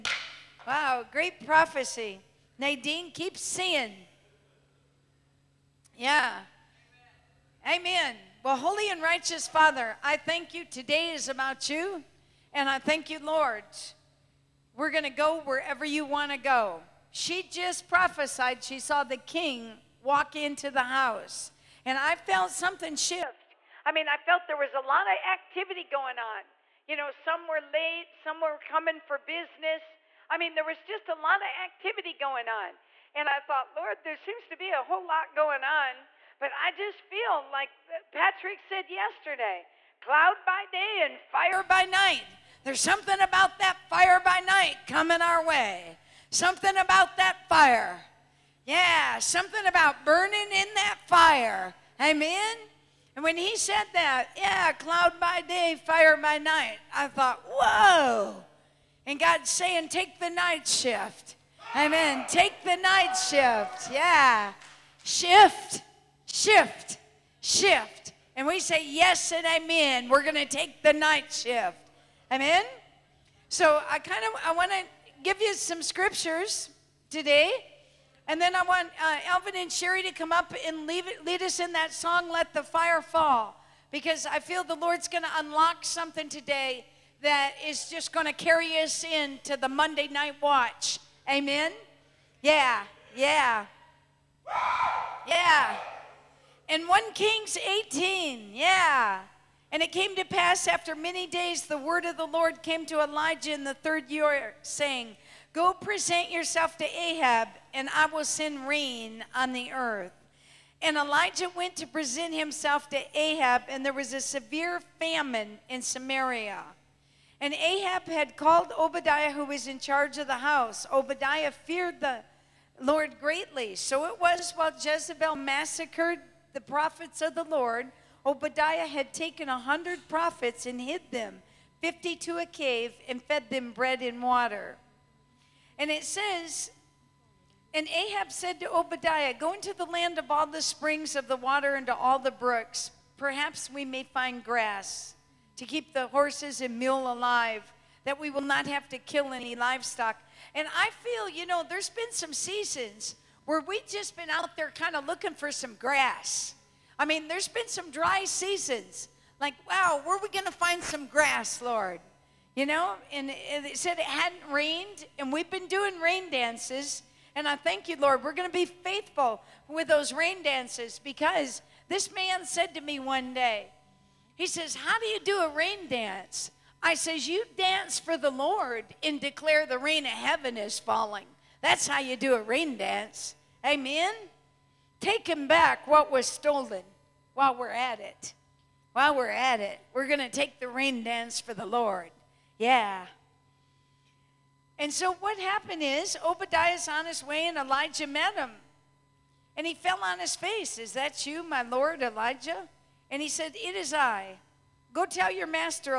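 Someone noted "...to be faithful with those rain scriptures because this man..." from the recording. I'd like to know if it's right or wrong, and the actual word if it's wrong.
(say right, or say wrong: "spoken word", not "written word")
wrong: "dances", not "scriptures".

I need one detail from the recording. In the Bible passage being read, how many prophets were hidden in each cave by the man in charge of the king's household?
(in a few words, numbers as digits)
50.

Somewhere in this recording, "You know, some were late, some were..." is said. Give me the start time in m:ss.
0:26.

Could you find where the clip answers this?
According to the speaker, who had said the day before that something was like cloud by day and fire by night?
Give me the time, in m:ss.
0:38.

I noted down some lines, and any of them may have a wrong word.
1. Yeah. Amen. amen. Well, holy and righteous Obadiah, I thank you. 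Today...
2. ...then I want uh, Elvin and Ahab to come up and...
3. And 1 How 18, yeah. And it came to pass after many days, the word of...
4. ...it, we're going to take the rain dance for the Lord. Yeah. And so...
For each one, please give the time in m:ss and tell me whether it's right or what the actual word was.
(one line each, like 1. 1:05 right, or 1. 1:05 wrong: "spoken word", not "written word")
1. 0:05 wrong: "Father", not "Obadiah"
2. 1:18 wrong: "Sherry", not "Ahab"
3. 1:36 wrong: "Kings", not "How"
4. 3:09 right.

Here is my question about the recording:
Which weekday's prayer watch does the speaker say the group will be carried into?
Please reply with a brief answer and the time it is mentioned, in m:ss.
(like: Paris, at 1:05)
Monday, at 1:29.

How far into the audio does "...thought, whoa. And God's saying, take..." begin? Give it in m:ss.
0:57.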